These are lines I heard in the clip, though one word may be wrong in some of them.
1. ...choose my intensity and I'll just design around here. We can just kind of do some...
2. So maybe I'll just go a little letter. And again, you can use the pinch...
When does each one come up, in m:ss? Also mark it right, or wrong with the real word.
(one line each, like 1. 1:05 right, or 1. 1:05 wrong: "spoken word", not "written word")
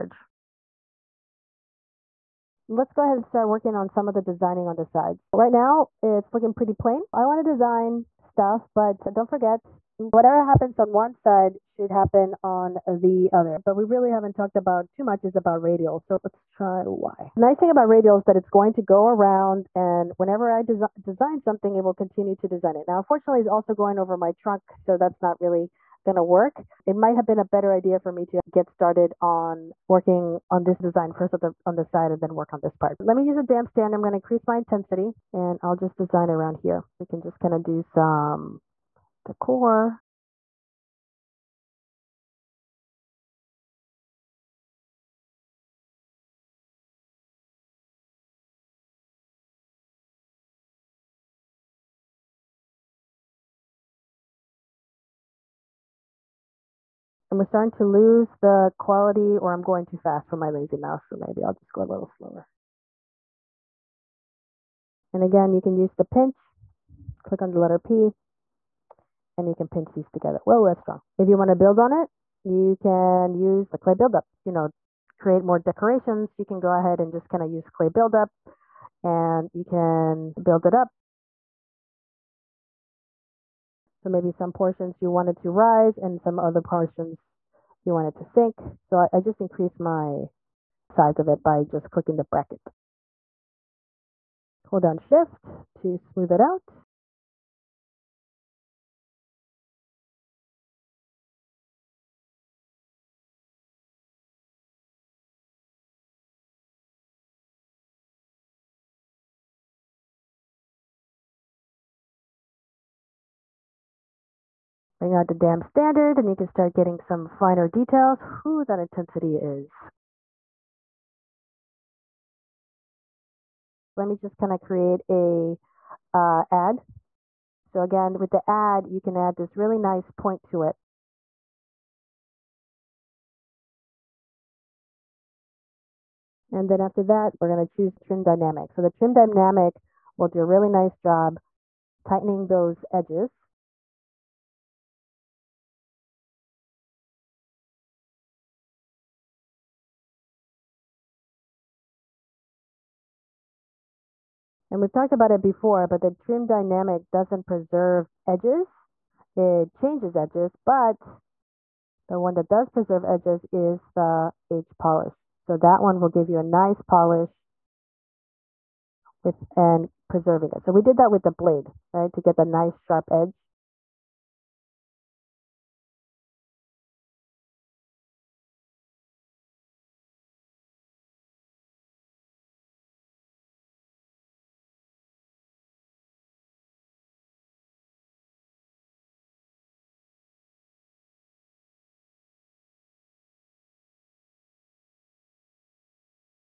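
1. 0:34 wrong: "increase", not "choose"
2. 1:01 wrong: "slower", not "letter".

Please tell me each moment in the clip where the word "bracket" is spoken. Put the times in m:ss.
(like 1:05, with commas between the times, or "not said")
1:32.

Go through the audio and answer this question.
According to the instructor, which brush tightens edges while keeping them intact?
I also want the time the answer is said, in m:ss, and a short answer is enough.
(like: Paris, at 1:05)
H polish, at 2:44.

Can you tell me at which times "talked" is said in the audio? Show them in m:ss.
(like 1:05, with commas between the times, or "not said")
0:14, 2:34.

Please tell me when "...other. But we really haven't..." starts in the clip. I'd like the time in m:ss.
0:13.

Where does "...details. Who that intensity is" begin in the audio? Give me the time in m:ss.
1:57.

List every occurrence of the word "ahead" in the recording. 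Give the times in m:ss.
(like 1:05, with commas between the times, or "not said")
0:03, 1:16.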